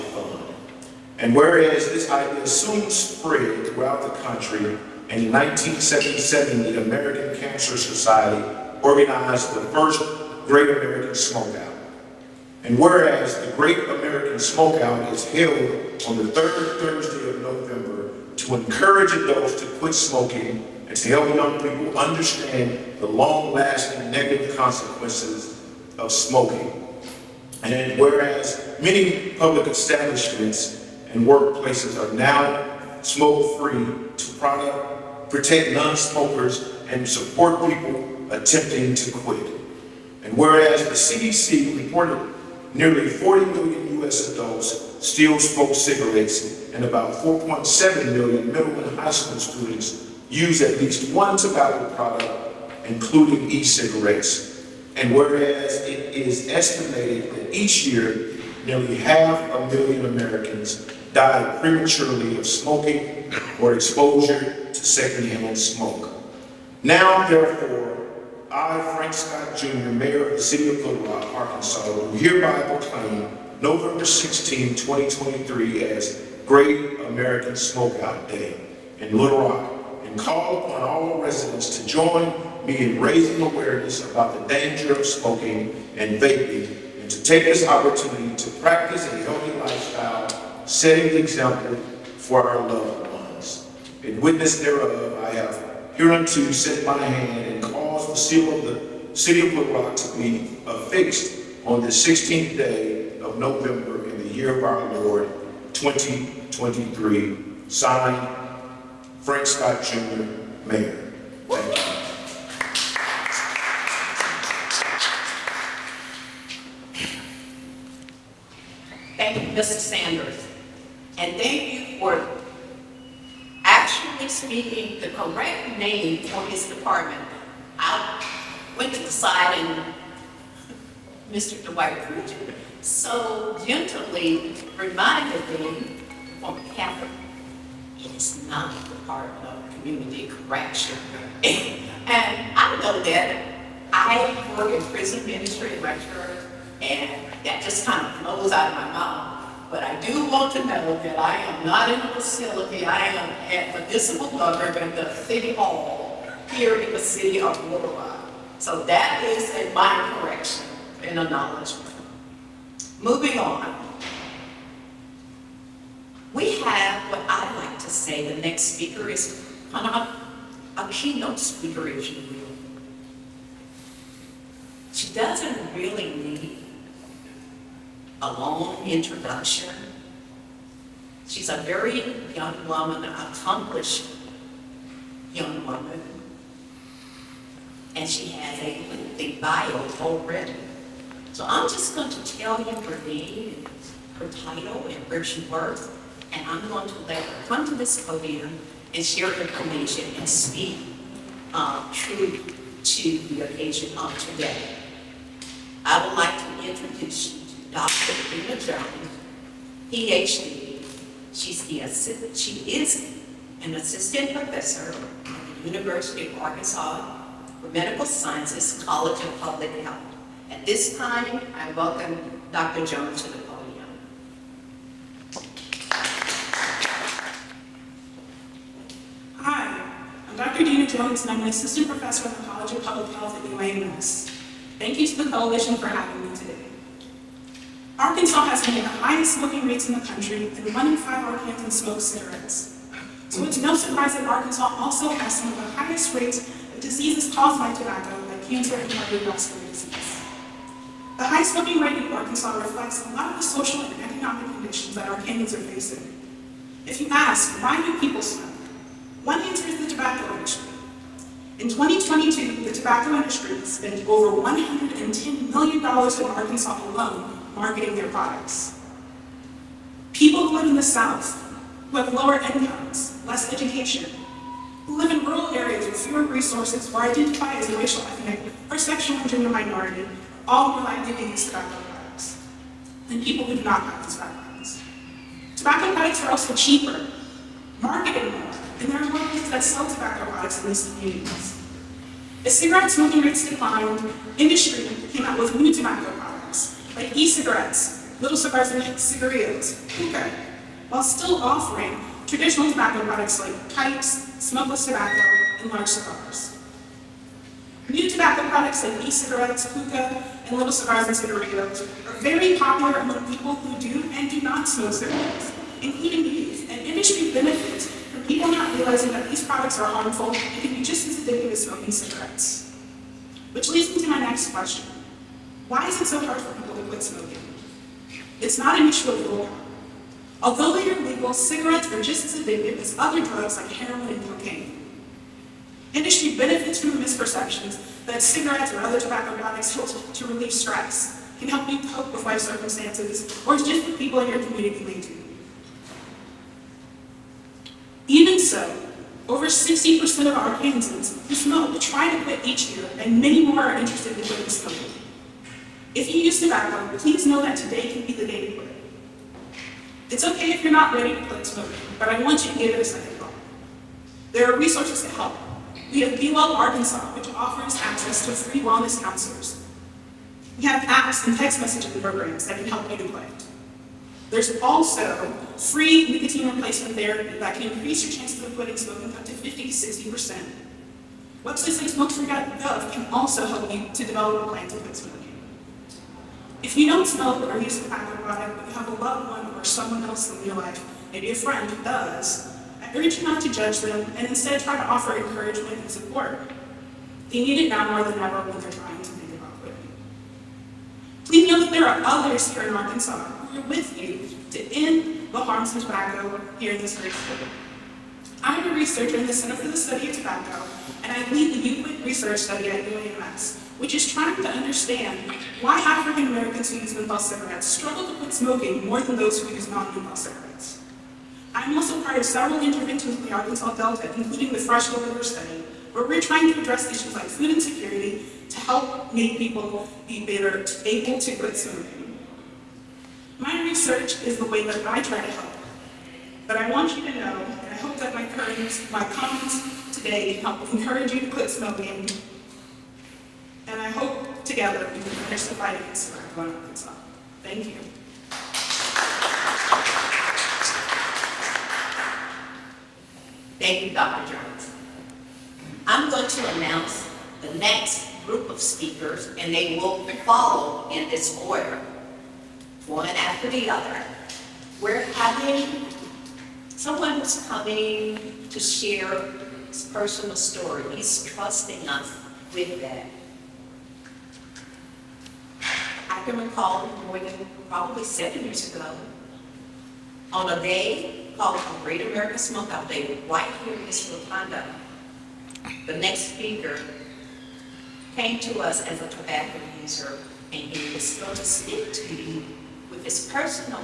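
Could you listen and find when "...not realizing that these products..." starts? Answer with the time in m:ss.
5:18.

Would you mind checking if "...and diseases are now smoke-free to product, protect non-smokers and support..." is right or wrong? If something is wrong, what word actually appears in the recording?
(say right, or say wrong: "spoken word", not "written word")
wrong: "workplaces", not "diseases".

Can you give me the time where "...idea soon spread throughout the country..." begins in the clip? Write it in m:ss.
0:02.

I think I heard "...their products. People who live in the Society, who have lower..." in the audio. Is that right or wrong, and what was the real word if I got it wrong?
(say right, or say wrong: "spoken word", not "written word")
wrong: "South", not "Society".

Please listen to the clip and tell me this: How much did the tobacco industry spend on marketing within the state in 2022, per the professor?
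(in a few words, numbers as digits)
Over $110 million.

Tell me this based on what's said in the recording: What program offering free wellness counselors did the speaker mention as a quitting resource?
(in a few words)
Be Well Arkansas.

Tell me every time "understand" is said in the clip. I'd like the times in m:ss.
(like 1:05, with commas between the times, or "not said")
0:21, 6:54.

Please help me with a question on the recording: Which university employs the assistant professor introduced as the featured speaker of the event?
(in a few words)
University of Arkansas for Medical Sciences.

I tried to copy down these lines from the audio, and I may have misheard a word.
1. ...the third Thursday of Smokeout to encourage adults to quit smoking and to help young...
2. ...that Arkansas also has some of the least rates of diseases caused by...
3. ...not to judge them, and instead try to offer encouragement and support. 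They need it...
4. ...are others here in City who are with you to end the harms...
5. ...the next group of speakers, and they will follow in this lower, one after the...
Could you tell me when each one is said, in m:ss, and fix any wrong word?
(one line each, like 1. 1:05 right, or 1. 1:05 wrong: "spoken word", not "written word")
1. 0:16 wrong: "November", not "Smokeout"
2. 4:04 wrong: "highest", not "least"
3. 6:33 right
4. 6:41 wrong: "Arkansas", not "City"
5. 7:37 wrong: "order", not "lower".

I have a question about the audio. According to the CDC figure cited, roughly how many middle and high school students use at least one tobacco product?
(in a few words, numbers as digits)
4.7 million.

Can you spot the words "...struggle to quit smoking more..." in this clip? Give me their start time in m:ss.
6:57.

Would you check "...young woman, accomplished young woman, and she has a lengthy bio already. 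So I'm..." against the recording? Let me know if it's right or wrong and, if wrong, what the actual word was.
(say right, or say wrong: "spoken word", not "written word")
right.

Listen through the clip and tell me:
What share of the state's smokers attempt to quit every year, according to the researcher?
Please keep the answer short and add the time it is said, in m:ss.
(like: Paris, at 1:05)
Over 60%, at 5:49.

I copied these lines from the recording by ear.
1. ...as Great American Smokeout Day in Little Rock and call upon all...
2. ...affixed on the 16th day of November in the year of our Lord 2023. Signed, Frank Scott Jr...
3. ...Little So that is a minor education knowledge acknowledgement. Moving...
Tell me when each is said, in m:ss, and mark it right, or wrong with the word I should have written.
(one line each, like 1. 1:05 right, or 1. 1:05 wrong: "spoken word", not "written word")
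1. 1:15 right
2. 1:40 right
3. 2:37 wrong: "correction", not "education".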